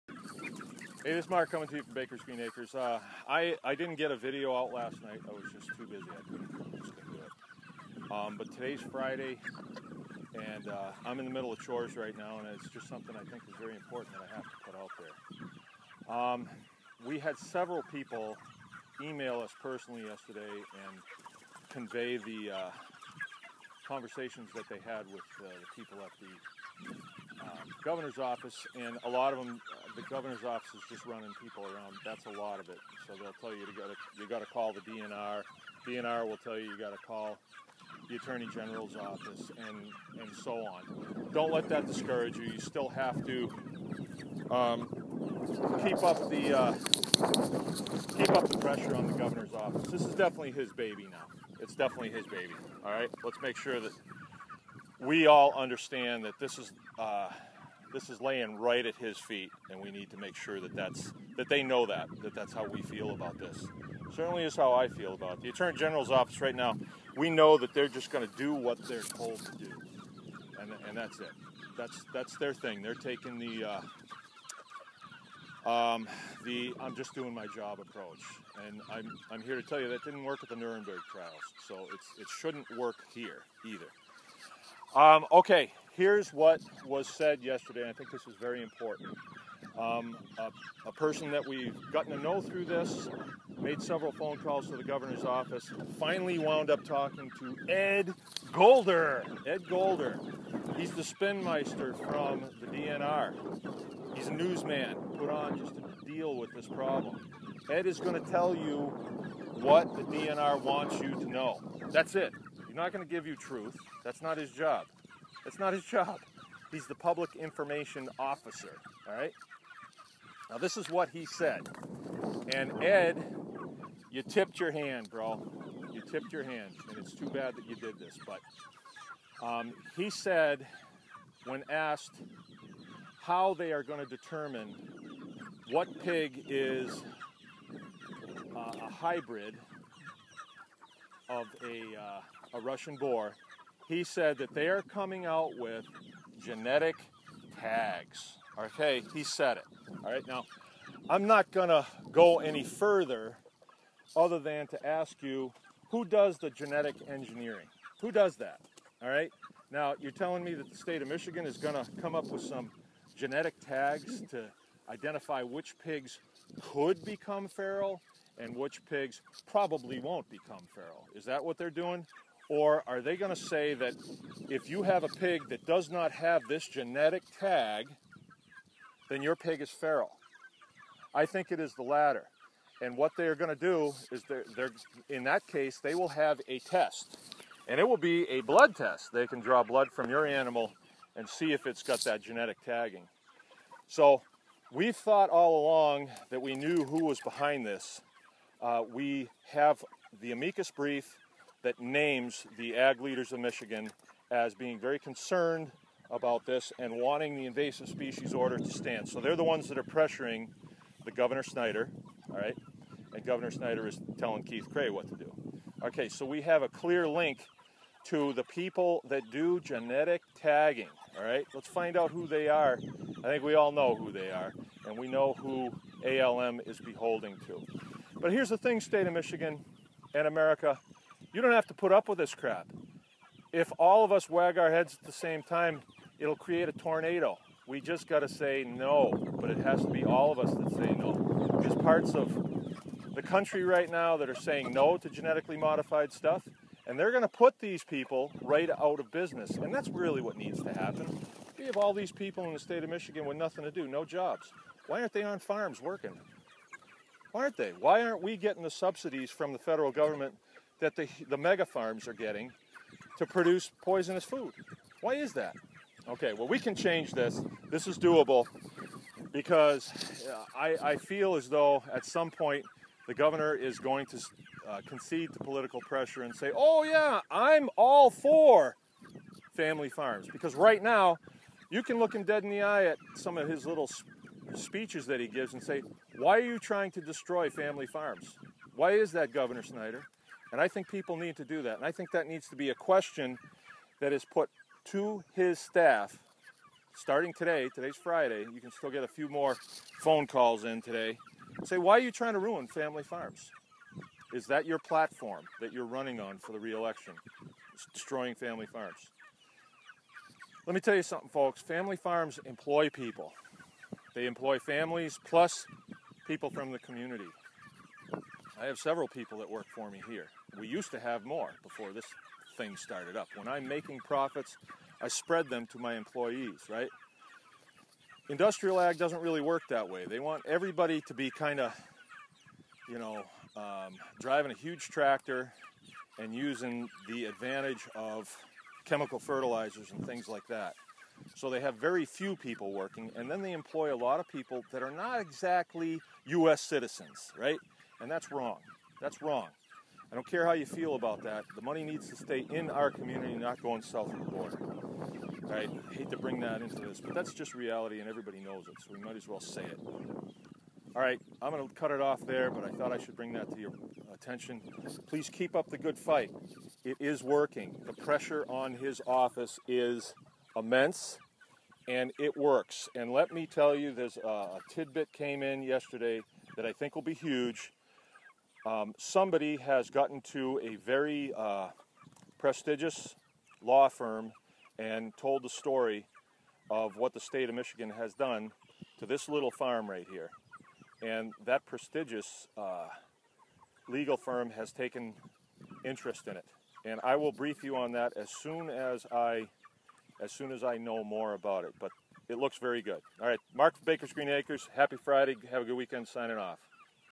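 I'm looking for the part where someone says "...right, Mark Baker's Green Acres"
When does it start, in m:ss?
6:43.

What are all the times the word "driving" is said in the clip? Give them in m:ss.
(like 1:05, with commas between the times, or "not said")
5:34.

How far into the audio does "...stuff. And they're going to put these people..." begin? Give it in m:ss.
4:06.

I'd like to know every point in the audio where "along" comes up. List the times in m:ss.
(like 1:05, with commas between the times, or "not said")
3:15.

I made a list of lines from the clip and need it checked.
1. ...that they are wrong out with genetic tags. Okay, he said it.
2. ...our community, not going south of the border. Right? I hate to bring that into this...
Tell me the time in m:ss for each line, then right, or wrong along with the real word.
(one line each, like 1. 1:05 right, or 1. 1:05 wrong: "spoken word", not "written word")
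1. 2:24 wrong: "coming", not "wrong"
2. 5:52 right.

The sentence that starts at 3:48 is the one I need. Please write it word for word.
But here's the thing, state of Michigan and America, you don't have to put up with this crap.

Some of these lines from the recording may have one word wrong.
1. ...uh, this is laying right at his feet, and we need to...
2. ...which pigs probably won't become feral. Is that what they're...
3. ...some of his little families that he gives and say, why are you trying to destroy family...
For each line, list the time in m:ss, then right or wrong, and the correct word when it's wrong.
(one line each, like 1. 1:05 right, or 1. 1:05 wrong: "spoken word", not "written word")
1. 0:56 right
2. 2:48 right
3. 4:43 wrong: "speeches", not "families".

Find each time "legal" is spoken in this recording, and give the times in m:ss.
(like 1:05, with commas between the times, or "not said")
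6:33.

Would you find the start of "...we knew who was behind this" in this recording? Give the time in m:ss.
3:16.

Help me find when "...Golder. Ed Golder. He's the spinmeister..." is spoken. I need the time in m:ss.
1:38.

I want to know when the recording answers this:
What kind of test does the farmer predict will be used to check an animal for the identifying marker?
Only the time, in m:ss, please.
3:08.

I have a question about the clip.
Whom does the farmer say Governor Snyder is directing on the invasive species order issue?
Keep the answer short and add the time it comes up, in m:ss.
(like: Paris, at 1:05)
Keith Creagh, at 3:34.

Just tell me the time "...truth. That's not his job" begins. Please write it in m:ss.
1:53.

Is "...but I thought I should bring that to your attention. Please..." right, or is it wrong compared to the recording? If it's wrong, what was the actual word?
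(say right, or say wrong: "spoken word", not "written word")
right.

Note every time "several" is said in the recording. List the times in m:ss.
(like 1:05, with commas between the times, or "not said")
0:17, 1:33, 5:18.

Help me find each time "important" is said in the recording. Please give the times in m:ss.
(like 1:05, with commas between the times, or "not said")
0:13, 1:28.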